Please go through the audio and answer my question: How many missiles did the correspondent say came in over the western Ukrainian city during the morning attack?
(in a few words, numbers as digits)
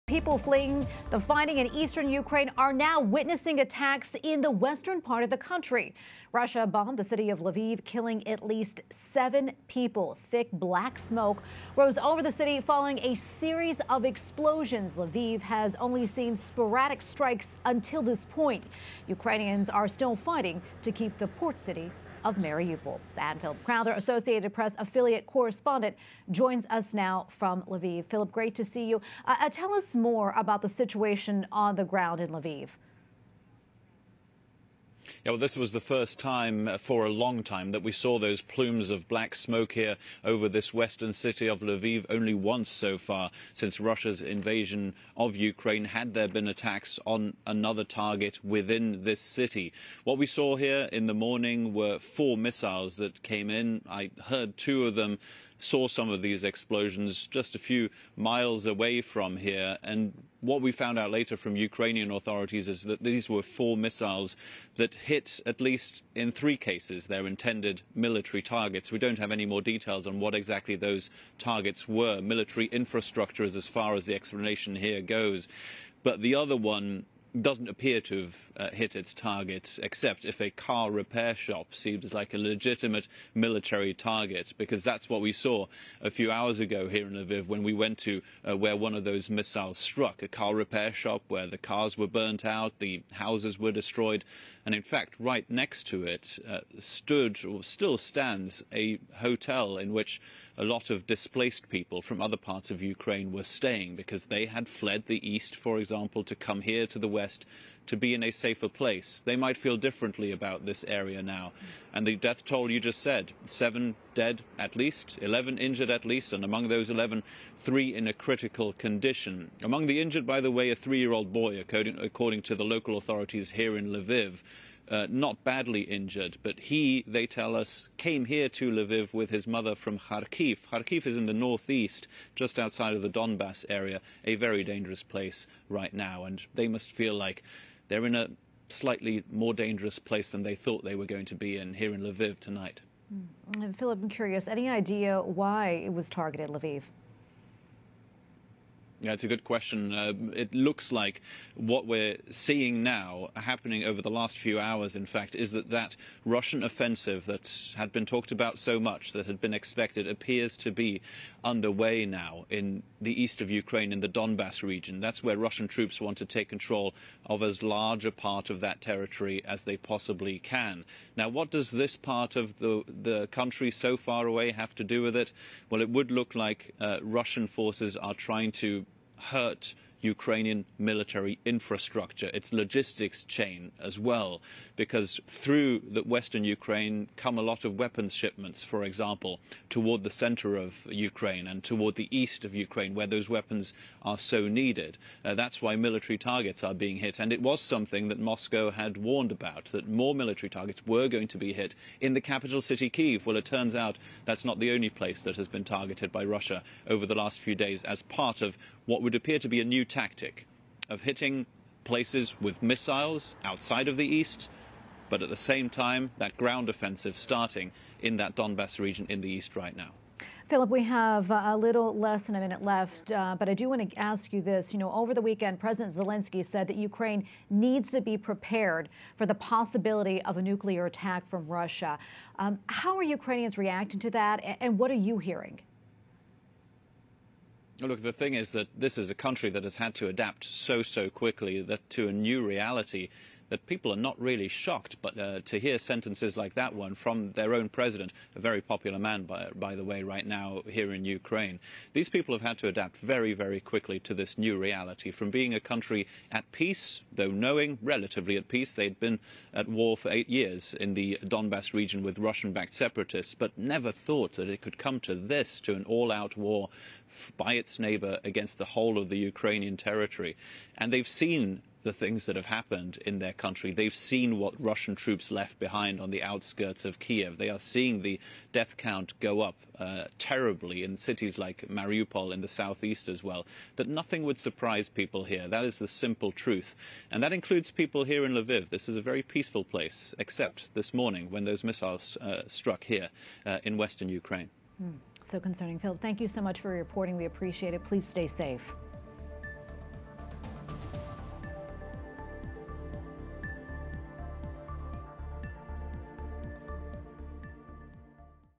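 4.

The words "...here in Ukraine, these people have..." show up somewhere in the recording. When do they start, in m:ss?
4:10.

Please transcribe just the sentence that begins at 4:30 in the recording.
And they've seen the things that have happened in their country.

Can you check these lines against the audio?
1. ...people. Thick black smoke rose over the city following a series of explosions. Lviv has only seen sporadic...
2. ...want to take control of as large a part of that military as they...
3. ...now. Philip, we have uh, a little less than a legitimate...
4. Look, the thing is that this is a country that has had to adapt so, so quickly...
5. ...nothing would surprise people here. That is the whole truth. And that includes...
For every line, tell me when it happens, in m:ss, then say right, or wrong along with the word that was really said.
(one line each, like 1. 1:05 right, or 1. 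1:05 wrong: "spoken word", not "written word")
1. 0:09 right
2. 2:45 wrong: "territory", not "military"
3. 3:39 wrong: "minute", not "legitimate"
4. 3:57 right
5. 4:43 wrong: "simple", not "whole".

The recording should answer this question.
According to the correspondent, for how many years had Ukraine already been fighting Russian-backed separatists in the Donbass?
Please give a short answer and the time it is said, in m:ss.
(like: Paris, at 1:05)
8, at 4:20.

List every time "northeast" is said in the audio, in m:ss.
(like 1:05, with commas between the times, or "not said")
2:11.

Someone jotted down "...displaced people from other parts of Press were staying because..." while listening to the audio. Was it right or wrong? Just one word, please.
wrong.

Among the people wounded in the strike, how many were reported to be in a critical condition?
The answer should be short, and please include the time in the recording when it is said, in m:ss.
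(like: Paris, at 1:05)
3, at 1:57.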